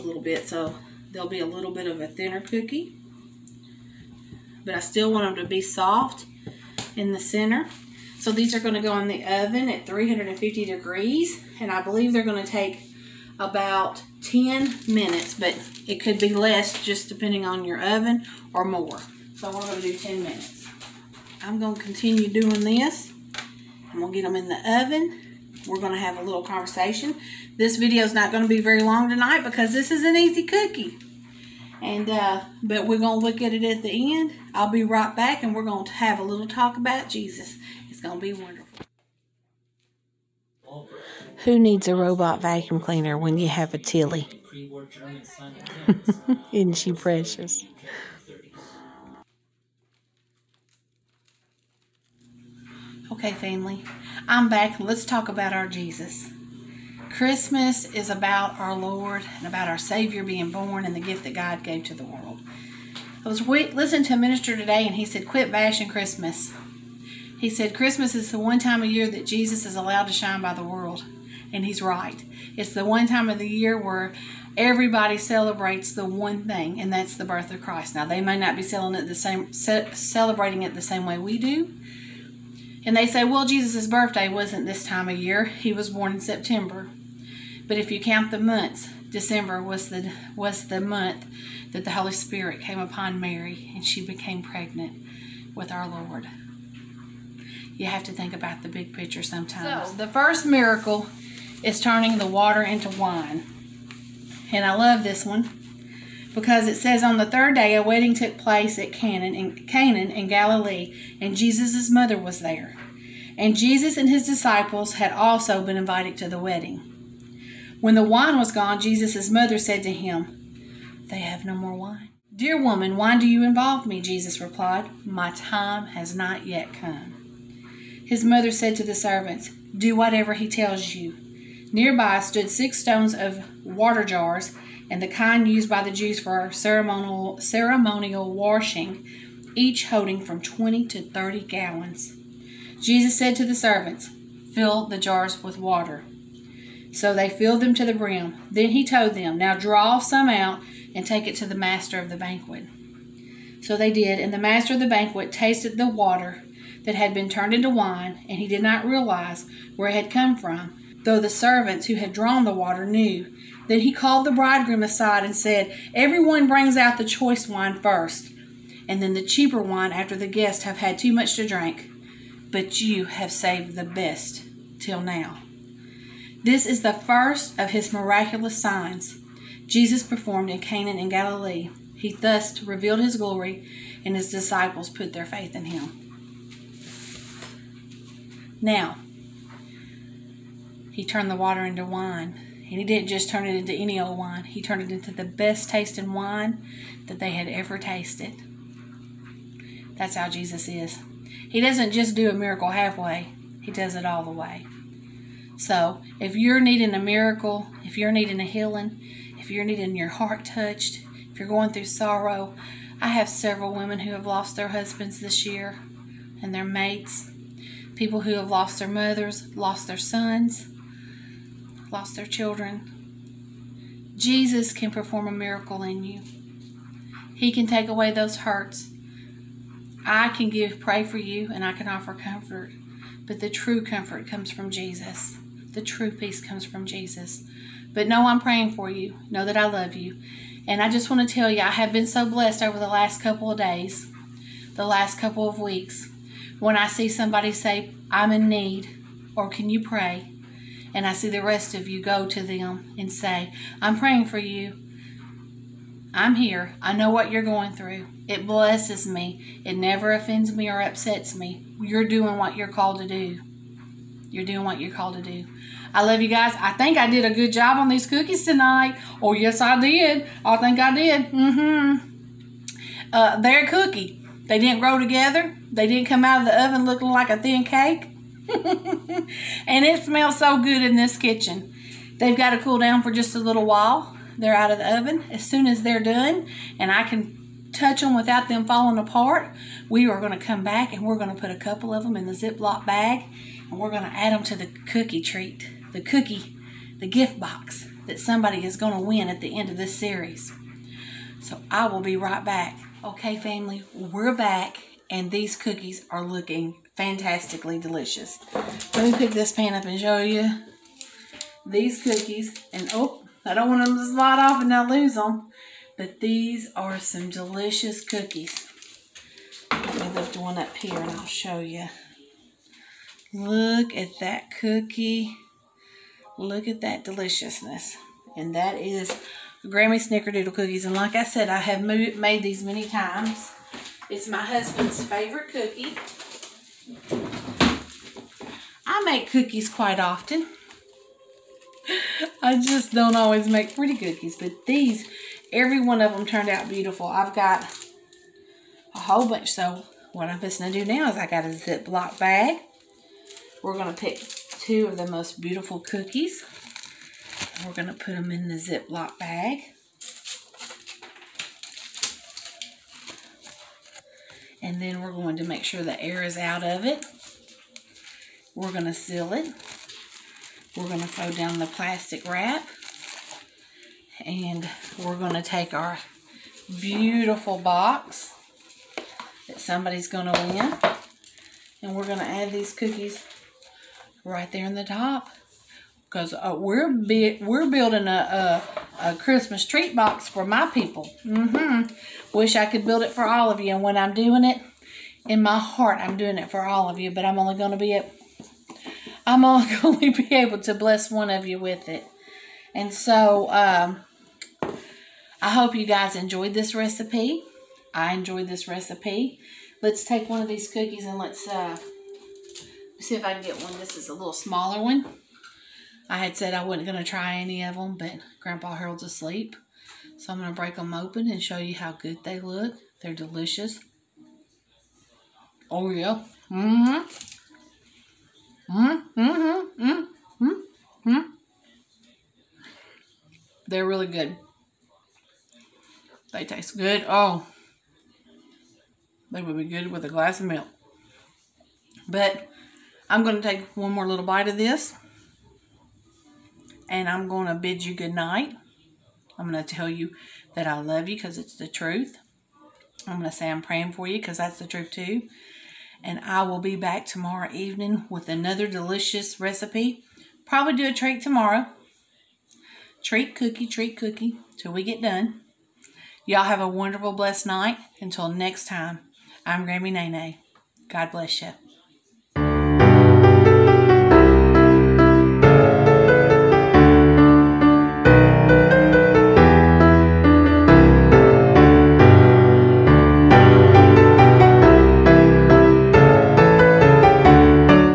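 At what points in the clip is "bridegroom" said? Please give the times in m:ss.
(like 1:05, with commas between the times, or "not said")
2:44.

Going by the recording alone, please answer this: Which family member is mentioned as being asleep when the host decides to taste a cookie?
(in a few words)
Grandpa Harold.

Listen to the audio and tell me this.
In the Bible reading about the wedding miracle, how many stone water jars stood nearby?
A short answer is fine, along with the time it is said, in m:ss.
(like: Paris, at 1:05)
6, at 2:12.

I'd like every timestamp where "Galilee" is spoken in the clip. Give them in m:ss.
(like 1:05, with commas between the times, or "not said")
1:50, 3:01.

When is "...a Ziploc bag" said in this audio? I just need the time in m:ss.
5:51.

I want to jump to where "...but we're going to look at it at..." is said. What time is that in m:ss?
0:32.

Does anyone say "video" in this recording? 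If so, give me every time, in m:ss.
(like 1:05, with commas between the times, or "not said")
0:27.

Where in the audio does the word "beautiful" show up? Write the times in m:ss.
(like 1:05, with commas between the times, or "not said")
5:46, 5:55, 6:16.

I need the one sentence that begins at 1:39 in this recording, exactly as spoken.
So, the first miracle is turning the water into wine.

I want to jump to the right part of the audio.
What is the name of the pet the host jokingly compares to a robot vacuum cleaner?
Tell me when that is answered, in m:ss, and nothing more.
0:43.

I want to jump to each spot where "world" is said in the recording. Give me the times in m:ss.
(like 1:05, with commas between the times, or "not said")
1:02, 1:10.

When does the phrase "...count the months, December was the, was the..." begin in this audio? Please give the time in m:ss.
1:28.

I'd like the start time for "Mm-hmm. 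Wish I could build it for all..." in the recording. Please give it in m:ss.
6:31.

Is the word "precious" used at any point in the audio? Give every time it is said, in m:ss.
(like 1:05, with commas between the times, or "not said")
0:46.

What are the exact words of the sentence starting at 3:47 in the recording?
He can take away those hurts.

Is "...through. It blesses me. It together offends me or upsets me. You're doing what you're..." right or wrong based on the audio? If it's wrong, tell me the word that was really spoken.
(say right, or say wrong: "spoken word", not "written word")
wrong: "never", not "together".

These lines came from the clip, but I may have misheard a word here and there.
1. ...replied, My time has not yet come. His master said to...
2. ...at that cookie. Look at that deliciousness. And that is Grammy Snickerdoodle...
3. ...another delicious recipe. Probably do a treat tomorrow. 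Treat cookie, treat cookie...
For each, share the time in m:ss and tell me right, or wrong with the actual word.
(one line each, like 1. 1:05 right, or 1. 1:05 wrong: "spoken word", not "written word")
1. 2:04 wrong: "mother", not "master"
2. 5:23 right
3. 7:38 right.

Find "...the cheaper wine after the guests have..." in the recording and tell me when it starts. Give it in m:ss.
2:49.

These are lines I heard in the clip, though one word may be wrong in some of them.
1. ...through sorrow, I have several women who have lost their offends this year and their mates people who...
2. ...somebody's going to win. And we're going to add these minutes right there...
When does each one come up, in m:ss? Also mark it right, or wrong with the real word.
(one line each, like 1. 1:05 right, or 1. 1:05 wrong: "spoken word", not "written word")
1. 3:31 wrong: "husbands", not "offends"
2. 6:19 wrong: "cookies", not "minutes".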